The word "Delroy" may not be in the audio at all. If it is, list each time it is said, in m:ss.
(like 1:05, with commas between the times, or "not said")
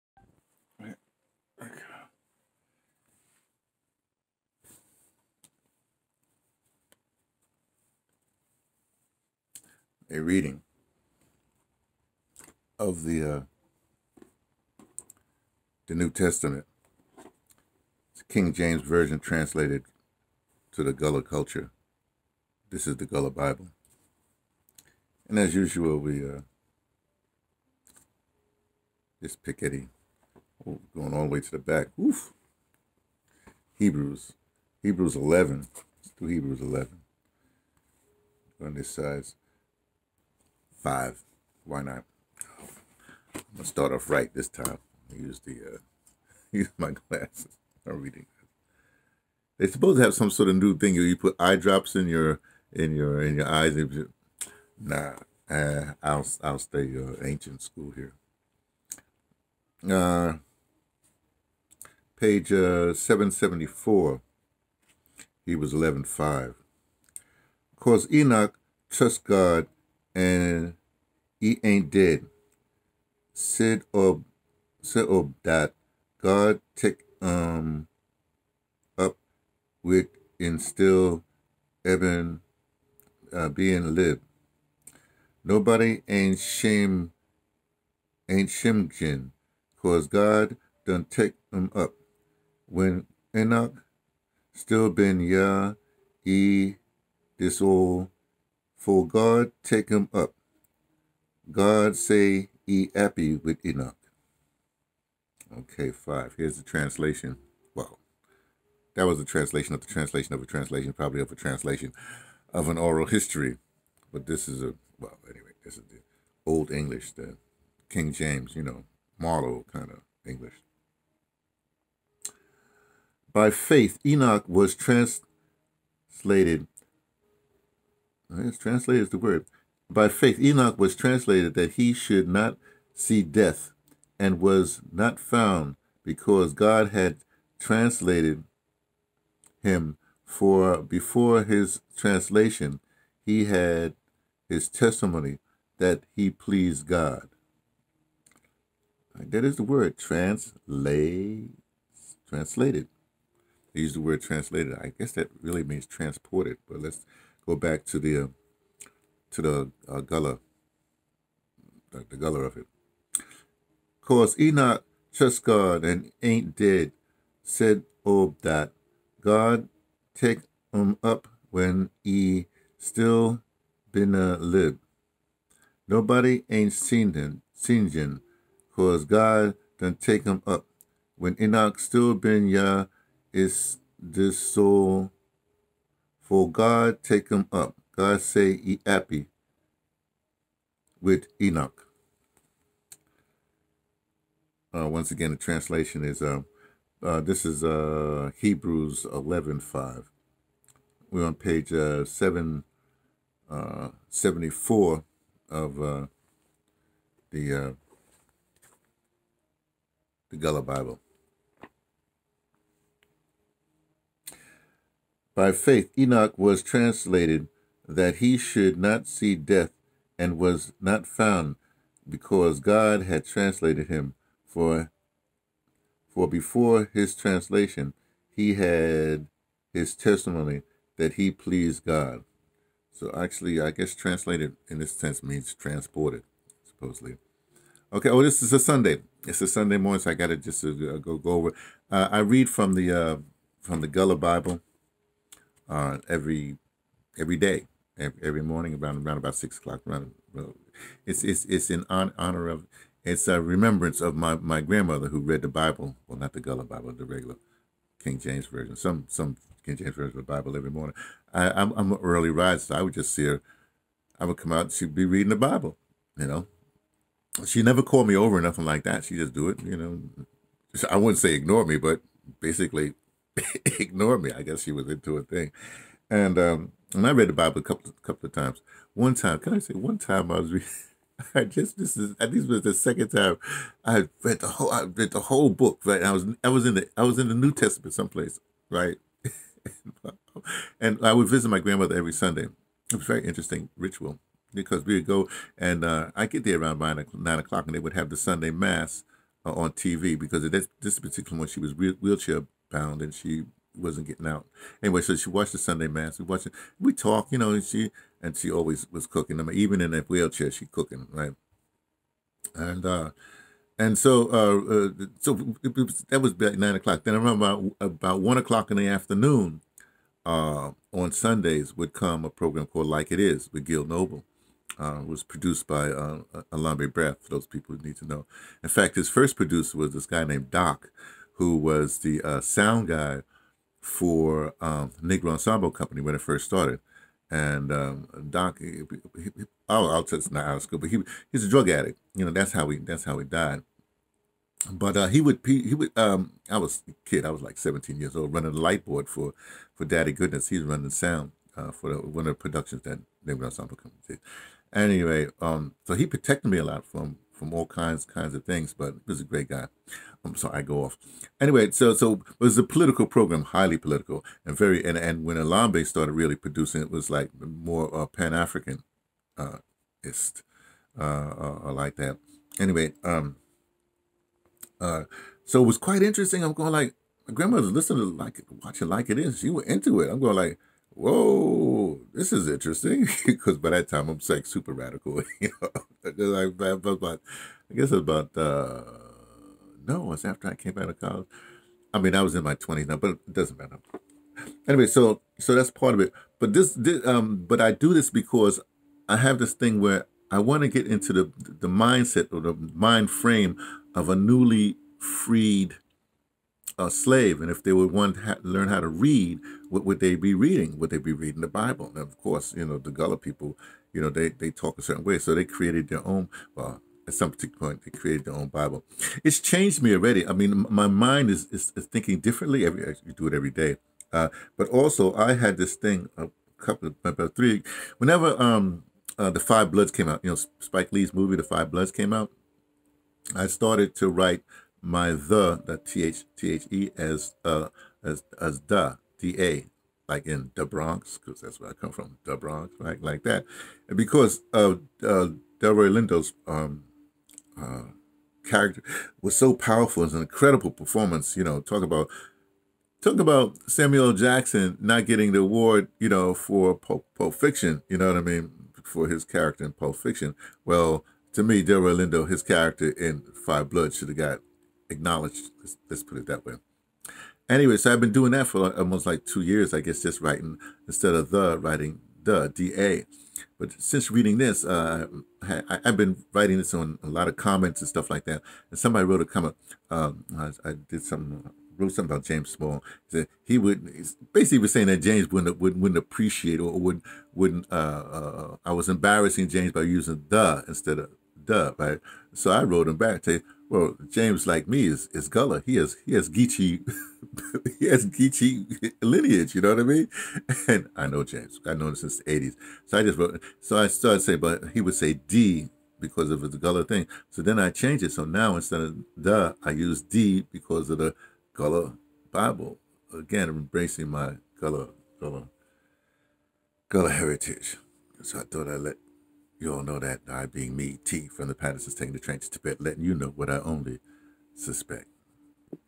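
7:25, 7:41.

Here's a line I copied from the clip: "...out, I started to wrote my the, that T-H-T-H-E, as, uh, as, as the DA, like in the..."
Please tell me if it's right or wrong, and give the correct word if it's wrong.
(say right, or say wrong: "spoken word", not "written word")
wrong: "write", not "wrote".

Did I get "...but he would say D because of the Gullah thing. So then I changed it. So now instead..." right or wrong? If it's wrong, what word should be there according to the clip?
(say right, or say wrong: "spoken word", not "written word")
right.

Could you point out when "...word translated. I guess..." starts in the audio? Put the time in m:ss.
2:34.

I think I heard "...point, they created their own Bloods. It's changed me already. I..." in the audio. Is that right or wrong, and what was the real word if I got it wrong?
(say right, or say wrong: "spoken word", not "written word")
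wrong: "Bible", not "Bloods".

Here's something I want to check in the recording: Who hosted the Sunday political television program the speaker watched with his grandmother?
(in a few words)
Gil Noble.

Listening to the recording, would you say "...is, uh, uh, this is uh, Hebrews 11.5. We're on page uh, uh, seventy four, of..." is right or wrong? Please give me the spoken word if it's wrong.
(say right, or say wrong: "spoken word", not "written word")
right.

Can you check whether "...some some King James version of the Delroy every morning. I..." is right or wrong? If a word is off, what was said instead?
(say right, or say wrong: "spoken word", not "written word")
wrong: "Bible", not "Delroy".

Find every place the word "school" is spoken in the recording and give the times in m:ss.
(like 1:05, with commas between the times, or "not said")
0:57, 5:40.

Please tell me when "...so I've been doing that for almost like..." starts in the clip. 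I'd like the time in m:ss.
7:47.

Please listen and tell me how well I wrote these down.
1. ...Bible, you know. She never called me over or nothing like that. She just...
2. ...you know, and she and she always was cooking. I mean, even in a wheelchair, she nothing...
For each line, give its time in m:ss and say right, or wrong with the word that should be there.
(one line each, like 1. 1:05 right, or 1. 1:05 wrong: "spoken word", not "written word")
1. 4:25 right
2. 5:07 wrong: "cooking", not "nothing".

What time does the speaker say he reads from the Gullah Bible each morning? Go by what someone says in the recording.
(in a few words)
6 o'clock.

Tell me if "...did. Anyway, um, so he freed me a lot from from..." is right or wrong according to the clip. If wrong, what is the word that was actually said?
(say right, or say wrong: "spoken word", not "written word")
wrong: "protected", not "freed".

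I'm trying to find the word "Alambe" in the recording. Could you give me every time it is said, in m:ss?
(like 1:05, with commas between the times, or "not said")
5:26, 6:05.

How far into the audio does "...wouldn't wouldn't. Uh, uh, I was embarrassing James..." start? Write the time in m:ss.
8:06.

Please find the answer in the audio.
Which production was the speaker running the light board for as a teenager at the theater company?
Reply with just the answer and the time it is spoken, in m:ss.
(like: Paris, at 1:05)
Daddy Goodness, at 5:49.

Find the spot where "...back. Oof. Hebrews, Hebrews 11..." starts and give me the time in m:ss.
0:31.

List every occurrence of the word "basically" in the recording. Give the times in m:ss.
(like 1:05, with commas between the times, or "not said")
4:32, 8:04.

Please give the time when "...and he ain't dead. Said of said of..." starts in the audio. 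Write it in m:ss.
1:10.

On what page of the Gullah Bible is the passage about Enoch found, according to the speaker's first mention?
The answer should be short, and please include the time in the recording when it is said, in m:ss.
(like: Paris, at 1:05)
774, at 1:02.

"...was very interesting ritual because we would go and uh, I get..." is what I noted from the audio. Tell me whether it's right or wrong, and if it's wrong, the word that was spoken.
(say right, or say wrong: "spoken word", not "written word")
right.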